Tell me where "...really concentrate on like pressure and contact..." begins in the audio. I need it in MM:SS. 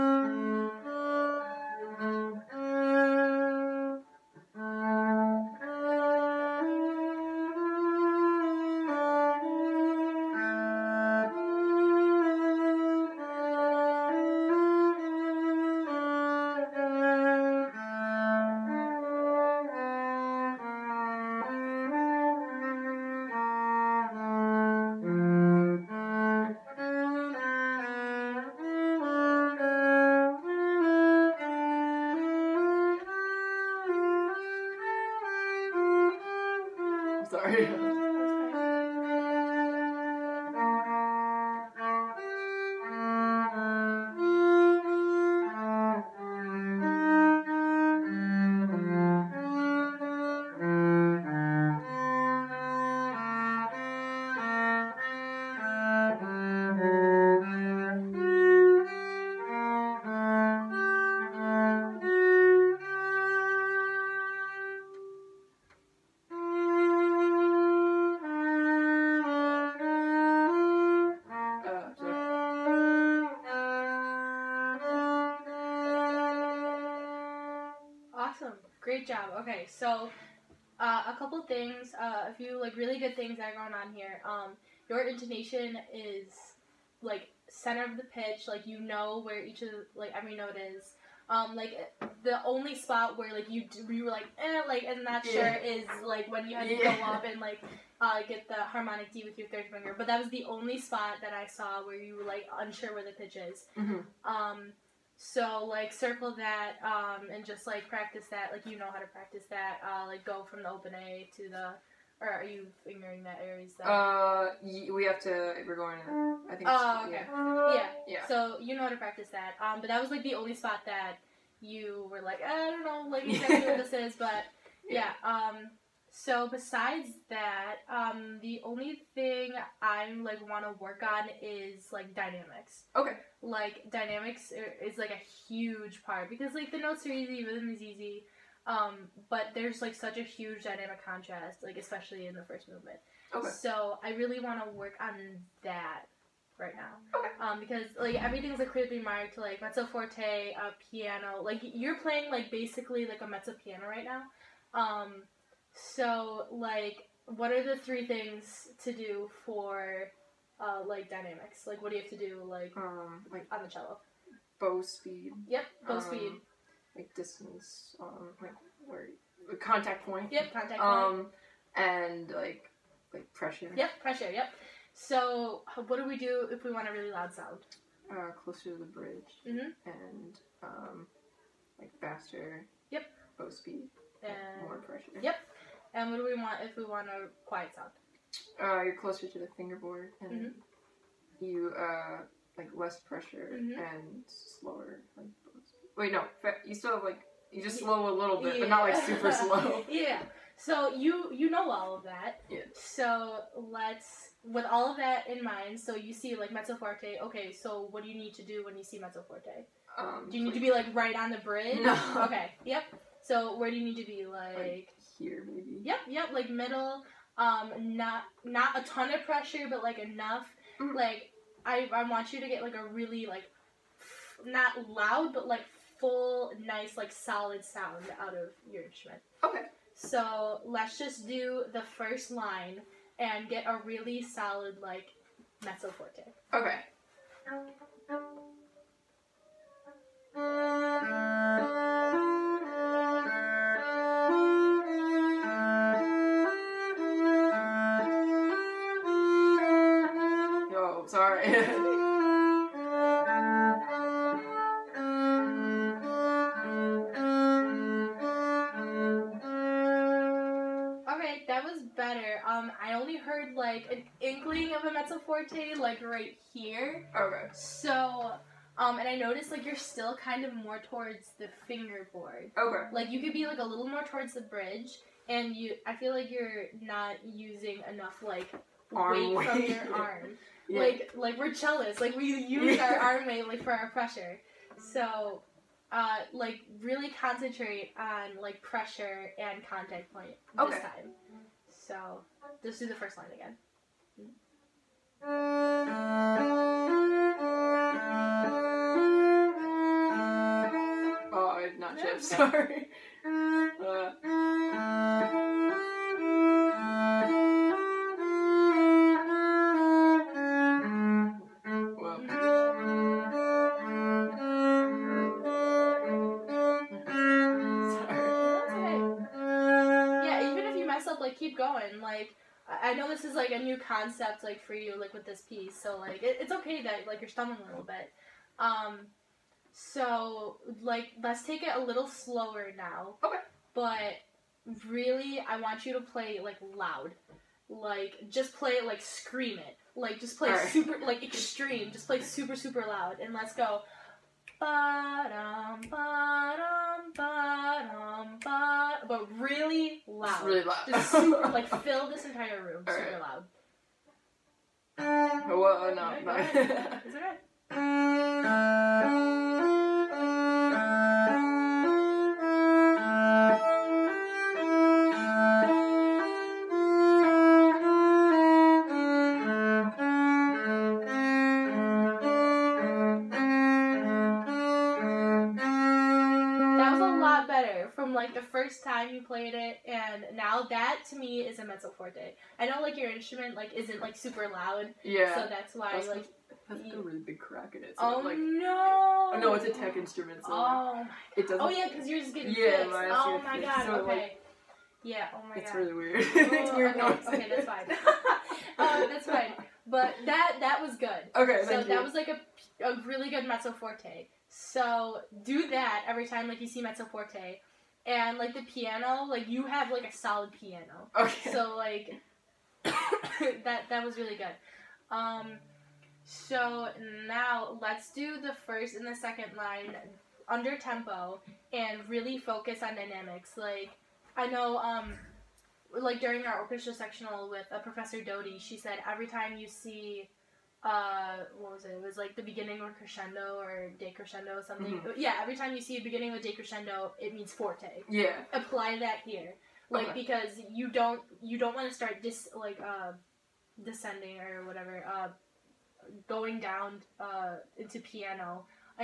04:46.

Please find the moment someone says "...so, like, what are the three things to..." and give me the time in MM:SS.
02:35.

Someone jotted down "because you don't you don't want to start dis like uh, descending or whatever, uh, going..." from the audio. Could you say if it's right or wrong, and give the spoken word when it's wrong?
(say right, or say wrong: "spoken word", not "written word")
right.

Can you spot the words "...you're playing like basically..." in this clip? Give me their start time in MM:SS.
02:31.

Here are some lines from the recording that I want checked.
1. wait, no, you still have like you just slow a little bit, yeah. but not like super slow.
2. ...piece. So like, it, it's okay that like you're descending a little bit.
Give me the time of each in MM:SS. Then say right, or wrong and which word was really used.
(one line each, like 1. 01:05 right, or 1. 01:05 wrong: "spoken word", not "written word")
1. 03:15 right
2. 05:25 wrong: "stumbling", not "descending".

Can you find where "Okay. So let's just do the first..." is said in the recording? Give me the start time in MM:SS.
03:49.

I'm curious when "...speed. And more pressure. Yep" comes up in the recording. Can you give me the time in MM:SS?
03:03.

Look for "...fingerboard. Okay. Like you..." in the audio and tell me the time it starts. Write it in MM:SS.
04:31.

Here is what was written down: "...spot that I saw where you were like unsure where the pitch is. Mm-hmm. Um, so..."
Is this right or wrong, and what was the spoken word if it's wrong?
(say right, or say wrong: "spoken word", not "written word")
right.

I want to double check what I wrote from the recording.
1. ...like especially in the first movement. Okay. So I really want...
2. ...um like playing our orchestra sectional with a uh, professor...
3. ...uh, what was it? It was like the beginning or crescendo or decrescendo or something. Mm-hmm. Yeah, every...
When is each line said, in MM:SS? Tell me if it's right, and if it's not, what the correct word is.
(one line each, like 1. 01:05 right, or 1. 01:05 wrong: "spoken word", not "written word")
1. 02:21 right
2. 07:04 wrong: "during", not "playing"
3. 07:10 right.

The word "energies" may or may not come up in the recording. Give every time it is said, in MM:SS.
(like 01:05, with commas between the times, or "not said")
not said.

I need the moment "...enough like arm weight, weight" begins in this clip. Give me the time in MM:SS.
04:37.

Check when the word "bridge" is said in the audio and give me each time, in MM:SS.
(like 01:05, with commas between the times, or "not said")
02:58, 03:31, 04:34.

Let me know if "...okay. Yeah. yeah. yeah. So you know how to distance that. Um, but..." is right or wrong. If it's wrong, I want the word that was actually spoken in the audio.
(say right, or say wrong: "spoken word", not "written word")
wrong: "practice", not "distance".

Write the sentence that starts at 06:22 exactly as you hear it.
I know like your instrument like isn't like super loud.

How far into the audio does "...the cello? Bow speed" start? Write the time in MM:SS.
02:43.